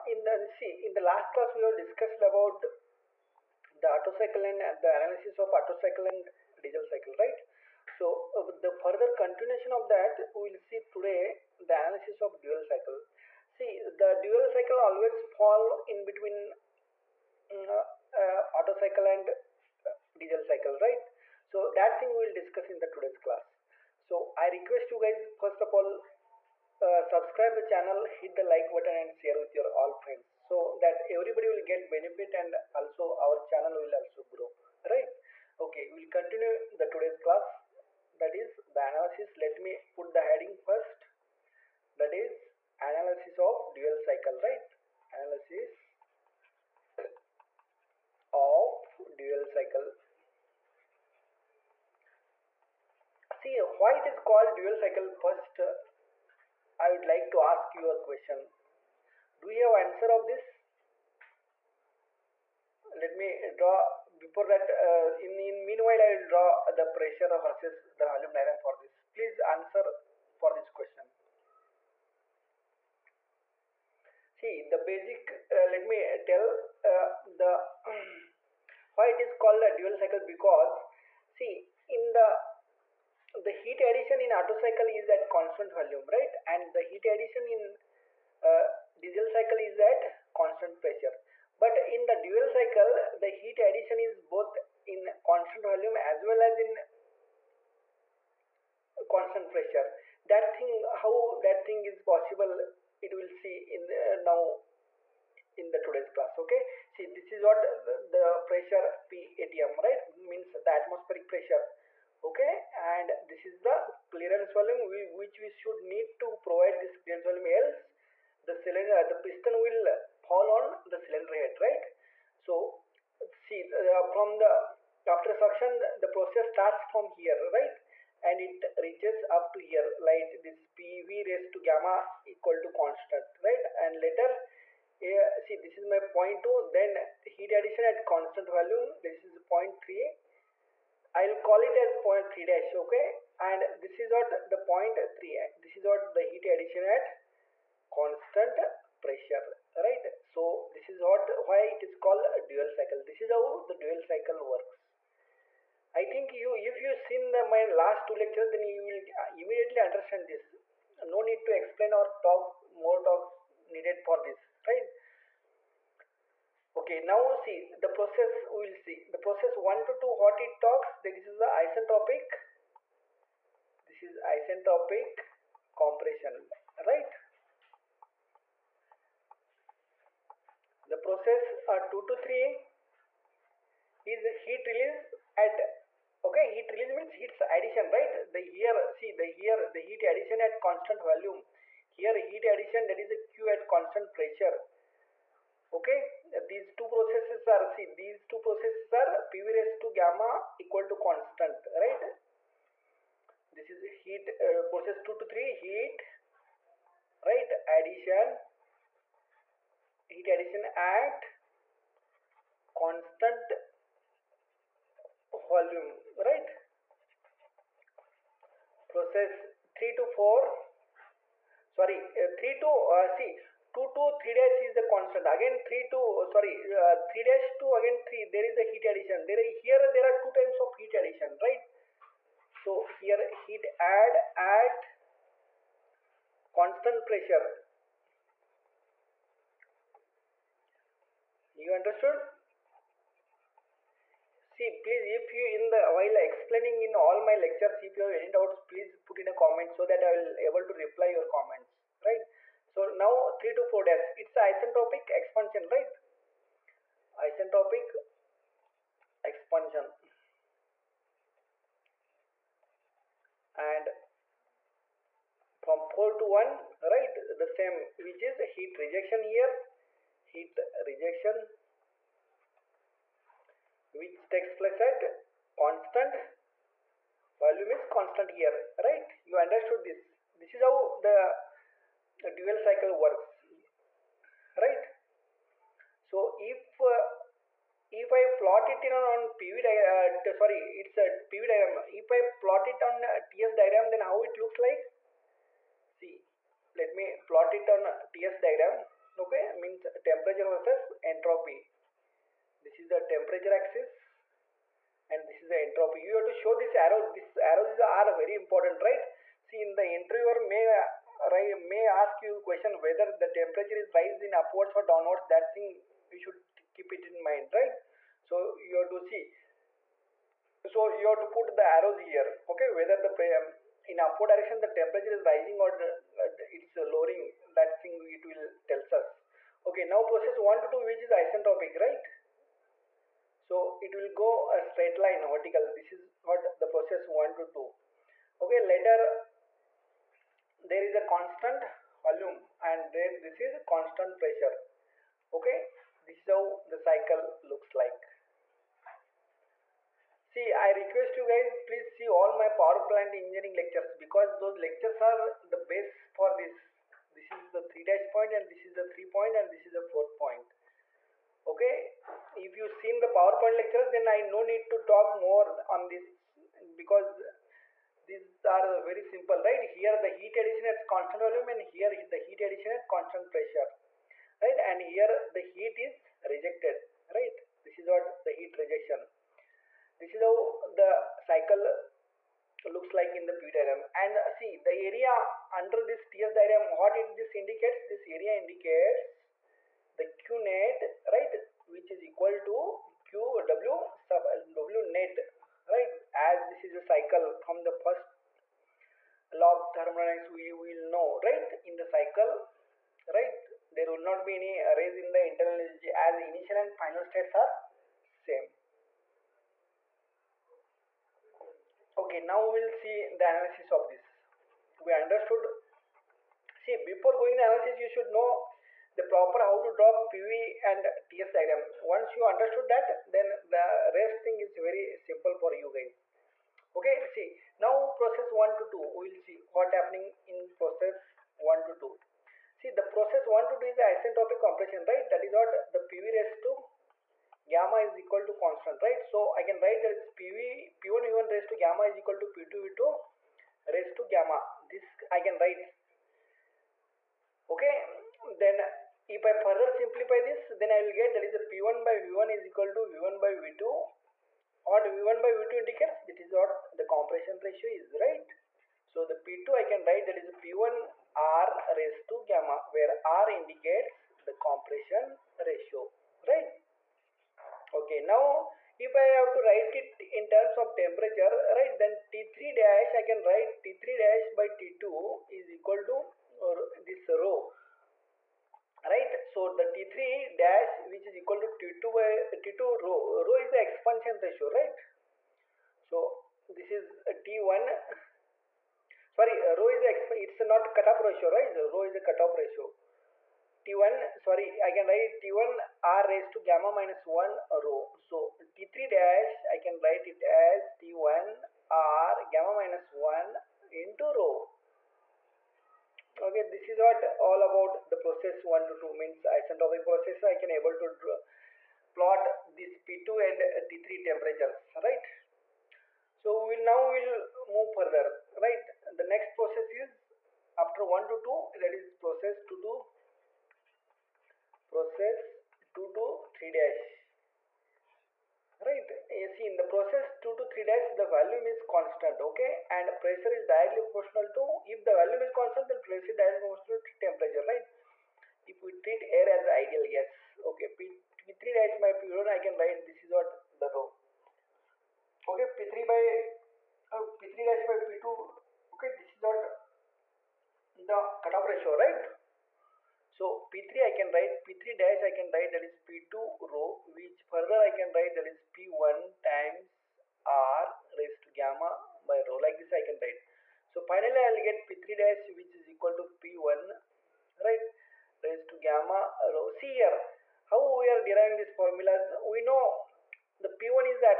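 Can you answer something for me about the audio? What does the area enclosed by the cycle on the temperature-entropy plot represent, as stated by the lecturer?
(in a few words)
q net.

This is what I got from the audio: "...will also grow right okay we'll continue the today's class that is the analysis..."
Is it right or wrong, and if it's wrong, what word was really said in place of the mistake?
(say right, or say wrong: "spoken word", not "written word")
right.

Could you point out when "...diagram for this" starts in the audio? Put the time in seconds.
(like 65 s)
68 s.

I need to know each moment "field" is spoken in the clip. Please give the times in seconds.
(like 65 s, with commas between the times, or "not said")
not said.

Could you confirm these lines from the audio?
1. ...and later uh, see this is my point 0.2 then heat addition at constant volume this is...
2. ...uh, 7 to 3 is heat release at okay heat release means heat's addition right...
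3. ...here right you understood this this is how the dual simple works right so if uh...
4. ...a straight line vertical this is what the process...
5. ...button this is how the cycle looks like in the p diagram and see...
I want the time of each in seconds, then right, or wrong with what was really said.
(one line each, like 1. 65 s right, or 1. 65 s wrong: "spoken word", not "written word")
1. 133 s right
2. 181 s wrong: "2", not "7"
3. 278 s wrong: "cycle", not "simple"
4. 334 s right
5. 378 s wrong: "rejection", not "button".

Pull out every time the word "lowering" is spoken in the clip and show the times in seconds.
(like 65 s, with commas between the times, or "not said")
326 s.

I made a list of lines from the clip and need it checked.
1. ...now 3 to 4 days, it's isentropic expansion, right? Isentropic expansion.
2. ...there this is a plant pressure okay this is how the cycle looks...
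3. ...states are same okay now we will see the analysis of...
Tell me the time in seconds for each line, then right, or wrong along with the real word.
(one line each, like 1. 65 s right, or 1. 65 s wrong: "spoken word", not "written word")
1. 252 s right
2. 342 s wrong: "constant", not "plant"
3. 407 s right.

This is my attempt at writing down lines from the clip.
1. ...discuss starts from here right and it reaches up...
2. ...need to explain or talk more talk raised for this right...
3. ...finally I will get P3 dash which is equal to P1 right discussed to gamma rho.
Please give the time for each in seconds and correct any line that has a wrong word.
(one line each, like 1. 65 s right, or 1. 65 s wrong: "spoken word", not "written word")
1. 126 s wrong: "process", not "discuss"
2. 161 s wrong: "needed", not "raised"
3. 563 s wrong: "raised", not "discussed".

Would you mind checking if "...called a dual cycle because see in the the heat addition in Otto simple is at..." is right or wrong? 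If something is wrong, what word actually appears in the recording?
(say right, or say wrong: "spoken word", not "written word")
wrong: "cycle", not "simple".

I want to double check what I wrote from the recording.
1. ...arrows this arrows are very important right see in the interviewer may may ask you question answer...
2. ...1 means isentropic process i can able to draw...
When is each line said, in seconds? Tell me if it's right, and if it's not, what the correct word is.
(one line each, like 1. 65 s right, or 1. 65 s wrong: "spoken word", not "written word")
1. 306 s wrong: "whether", not "answer"
2. 508 s wrong: "2", not "1".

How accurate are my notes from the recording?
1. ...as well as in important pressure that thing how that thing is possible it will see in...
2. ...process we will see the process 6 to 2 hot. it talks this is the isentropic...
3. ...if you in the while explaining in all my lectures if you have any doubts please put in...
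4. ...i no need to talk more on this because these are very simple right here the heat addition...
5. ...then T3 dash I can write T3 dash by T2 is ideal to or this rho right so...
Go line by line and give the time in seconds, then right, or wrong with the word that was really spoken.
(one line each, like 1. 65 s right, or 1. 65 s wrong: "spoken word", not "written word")
1. 95 s wrong: "constant", not "important"
2. 167 s wrong: "1", not "6"
3. 245 s right
4. 364 s right
5. 471 s wrong: "equal", not "ideal".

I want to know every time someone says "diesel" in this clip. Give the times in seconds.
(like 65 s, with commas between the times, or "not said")
6 s, 20 s, 88 s.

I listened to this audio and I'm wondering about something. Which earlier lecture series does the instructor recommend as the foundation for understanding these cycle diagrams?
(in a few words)
power plant engineering.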